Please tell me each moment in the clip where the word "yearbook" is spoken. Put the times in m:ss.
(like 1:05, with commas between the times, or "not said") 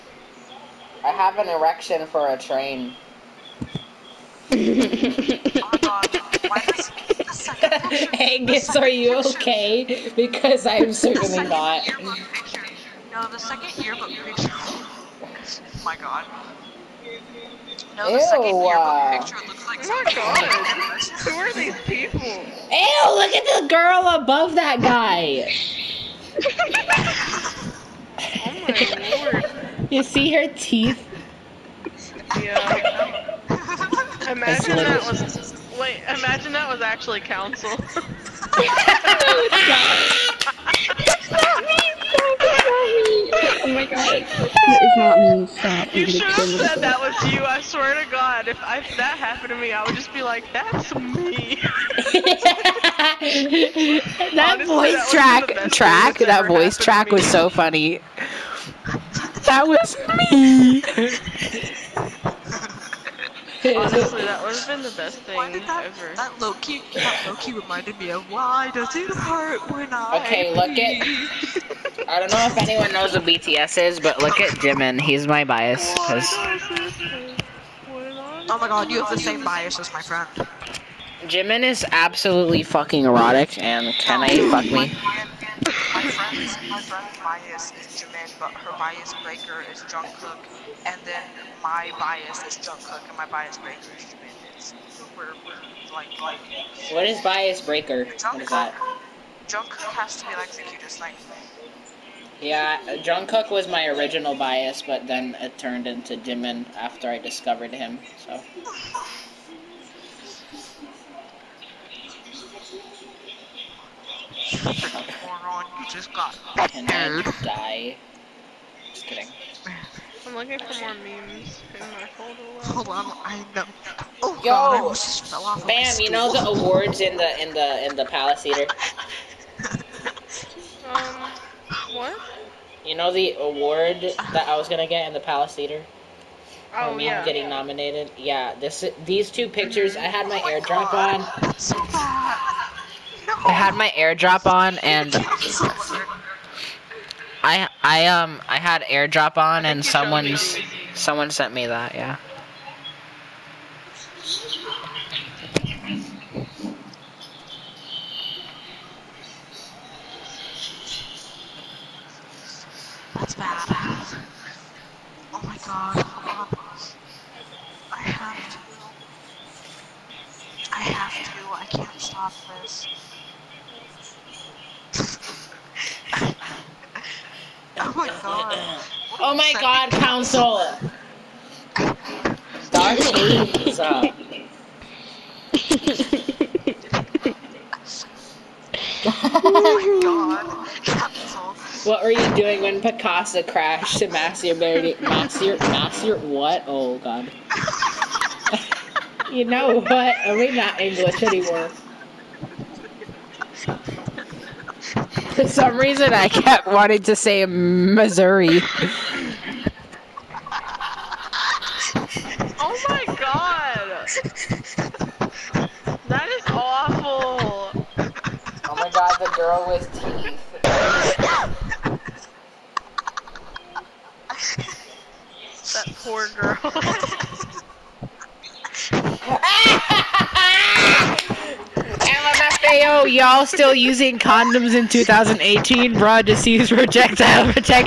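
0:13, 0:18.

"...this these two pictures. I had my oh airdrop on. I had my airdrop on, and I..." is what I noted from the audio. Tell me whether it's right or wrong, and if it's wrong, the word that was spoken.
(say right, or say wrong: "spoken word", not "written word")
right.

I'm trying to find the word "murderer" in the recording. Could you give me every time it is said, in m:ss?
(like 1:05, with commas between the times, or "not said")
not said.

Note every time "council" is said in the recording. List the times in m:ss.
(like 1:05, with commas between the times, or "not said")
0:37, 2:59.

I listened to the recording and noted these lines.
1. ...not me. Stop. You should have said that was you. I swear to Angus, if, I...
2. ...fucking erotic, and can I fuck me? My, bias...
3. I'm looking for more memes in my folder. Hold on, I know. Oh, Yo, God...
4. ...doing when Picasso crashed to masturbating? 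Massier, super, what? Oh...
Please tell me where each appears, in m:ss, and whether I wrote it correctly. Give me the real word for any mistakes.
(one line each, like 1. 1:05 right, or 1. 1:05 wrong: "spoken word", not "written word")
1. 0:44 wrong: "God", not "Angus"
2. 1:22 right
3. 2:00 right
4. 3:12 wrong: "master", not "super".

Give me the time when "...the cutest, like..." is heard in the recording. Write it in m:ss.
1:40.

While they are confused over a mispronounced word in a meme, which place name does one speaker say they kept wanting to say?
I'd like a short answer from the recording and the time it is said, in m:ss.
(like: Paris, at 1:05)
Missouri, at 3:27.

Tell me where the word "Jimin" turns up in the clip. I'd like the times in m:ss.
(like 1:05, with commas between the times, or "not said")
1:14, 1:21, 1:28, 1:34, 1:46.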